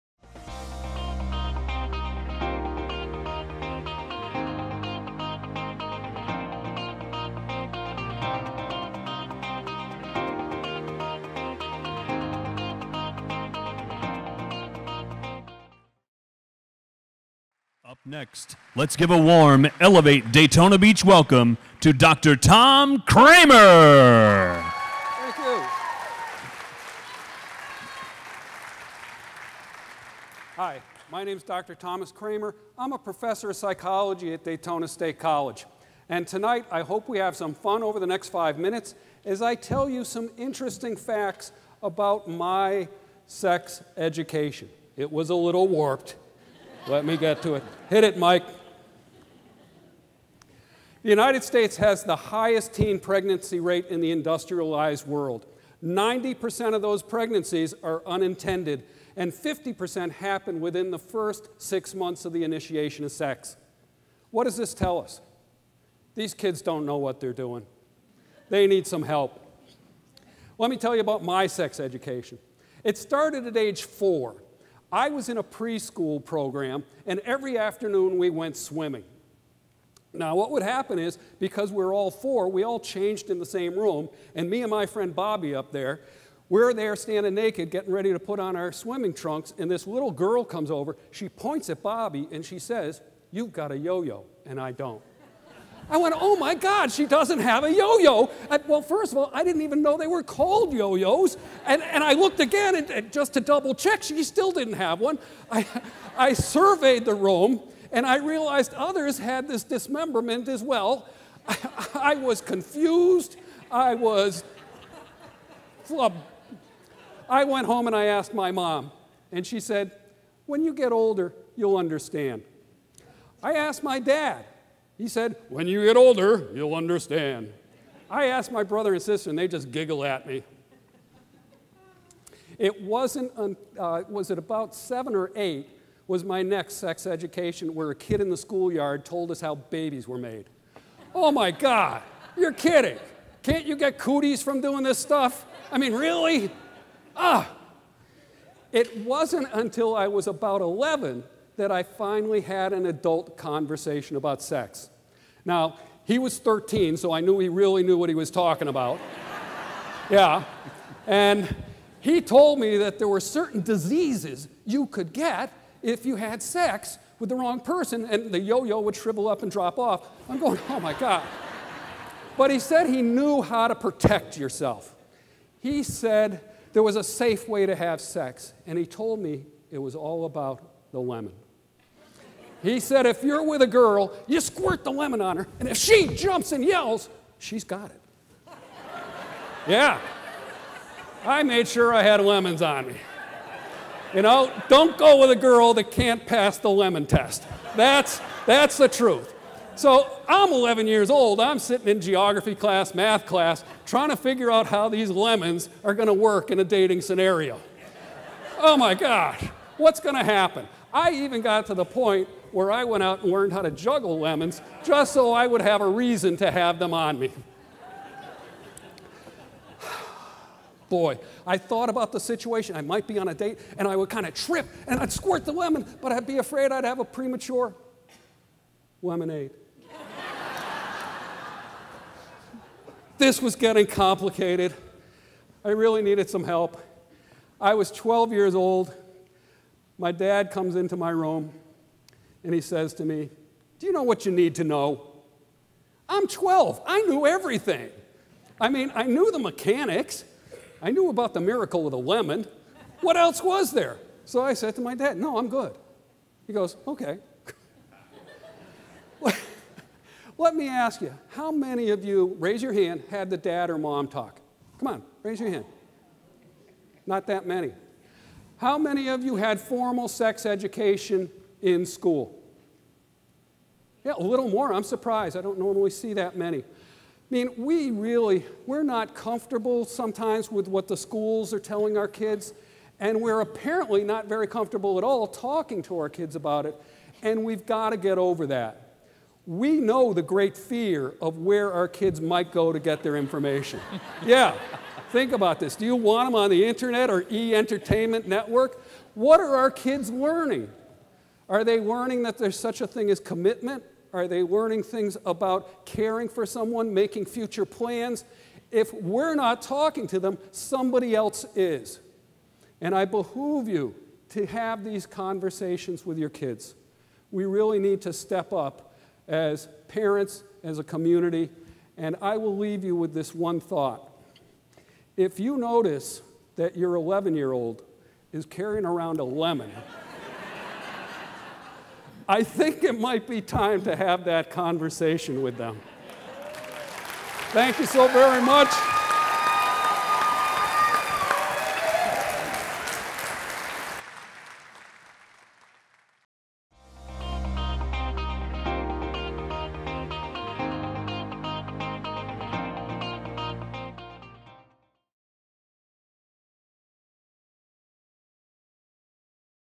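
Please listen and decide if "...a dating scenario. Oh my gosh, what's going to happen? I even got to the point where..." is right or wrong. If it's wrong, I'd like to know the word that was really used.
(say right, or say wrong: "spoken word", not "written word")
right.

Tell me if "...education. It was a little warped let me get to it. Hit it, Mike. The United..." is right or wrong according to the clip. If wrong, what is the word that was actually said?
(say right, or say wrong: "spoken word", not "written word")
right.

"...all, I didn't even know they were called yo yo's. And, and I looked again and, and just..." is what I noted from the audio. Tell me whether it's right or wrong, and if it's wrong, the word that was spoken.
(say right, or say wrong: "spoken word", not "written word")
right.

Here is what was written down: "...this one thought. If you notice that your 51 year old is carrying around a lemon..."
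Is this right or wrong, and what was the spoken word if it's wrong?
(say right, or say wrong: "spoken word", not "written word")
wrong: "11", not "51".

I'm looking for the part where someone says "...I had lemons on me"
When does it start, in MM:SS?
03:11.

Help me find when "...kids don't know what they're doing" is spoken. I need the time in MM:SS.
01:06.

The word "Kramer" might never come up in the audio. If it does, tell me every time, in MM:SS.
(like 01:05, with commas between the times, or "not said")
00:23, 00:32.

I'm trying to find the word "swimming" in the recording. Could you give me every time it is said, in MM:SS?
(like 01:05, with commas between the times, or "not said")
01:18, 01:28.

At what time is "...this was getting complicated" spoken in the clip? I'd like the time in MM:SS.
03:53.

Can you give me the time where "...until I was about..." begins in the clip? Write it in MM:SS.
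02:29.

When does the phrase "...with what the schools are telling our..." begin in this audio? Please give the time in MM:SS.
04:40.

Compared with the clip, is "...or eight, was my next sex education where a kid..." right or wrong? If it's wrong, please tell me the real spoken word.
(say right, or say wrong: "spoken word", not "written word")
right.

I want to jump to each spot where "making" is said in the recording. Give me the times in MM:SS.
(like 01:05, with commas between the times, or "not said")
05:06.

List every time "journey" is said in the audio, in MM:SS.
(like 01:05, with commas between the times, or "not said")
not said.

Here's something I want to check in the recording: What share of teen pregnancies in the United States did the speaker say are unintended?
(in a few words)
90%.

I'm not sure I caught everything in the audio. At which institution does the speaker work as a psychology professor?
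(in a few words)
Daytona State College.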